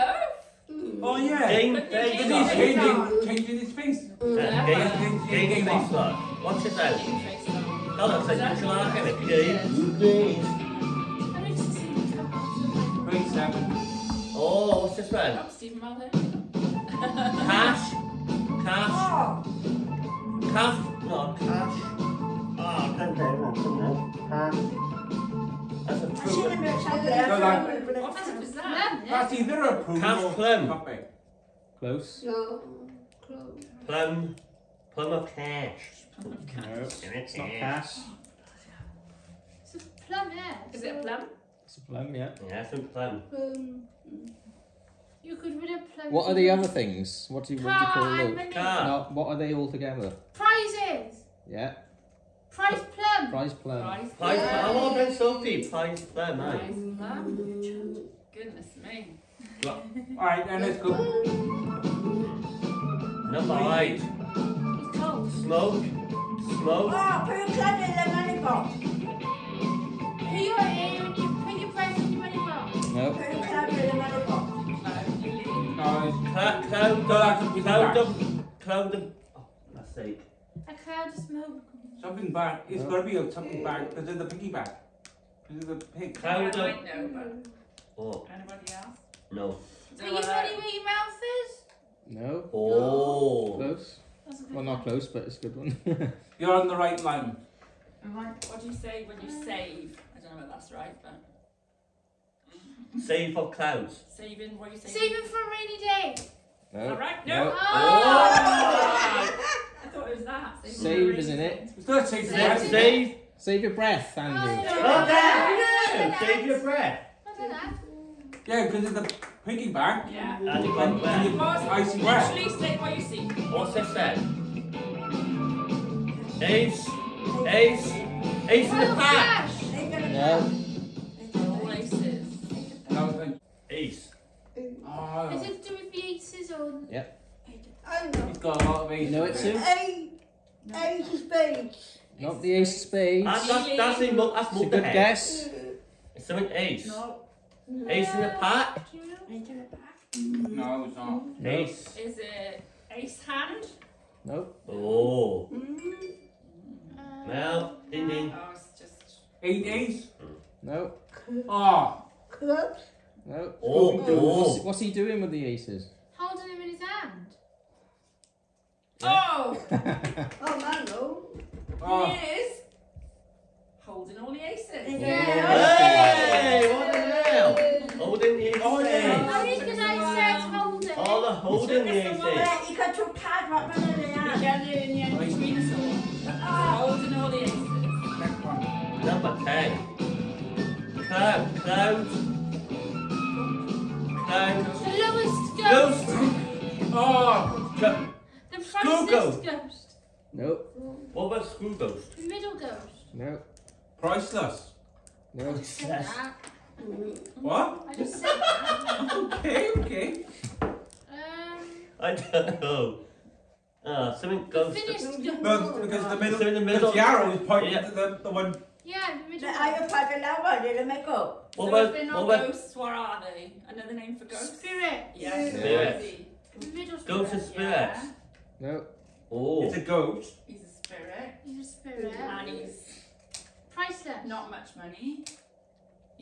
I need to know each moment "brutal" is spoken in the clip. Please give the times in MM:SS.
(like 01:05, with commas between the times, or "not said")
not said.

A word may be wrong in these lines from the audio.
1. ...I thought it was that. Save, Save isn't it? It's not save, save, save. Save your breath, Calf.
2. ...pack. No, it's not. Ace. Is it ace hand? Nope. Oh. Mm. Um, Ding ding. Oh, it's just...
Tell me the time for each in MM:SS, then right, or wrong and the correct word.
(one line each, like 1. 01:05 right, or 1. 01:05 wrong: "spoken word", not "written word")
1. 01:49 wrong: "Andy", not "Calf"
2. 02:29 right.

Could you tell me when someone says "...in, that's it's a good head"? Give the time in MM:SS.
02:24.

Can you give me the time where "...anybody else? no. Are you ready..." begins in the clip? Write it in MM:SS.
01:28.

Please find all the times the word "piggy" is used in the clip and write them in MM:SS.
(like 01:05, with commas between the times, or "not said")
01:24, 01:59.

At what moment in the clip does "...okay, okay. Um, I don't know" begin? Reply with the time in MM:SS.
03:29.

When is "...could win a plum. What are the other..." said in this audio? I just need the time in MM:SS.
00:45.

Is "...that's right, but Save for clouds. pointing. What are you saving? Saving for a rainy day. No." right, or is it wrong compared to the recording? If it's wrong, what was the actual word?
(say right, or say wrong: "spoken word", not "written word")
wrong: "saving", not "pointing".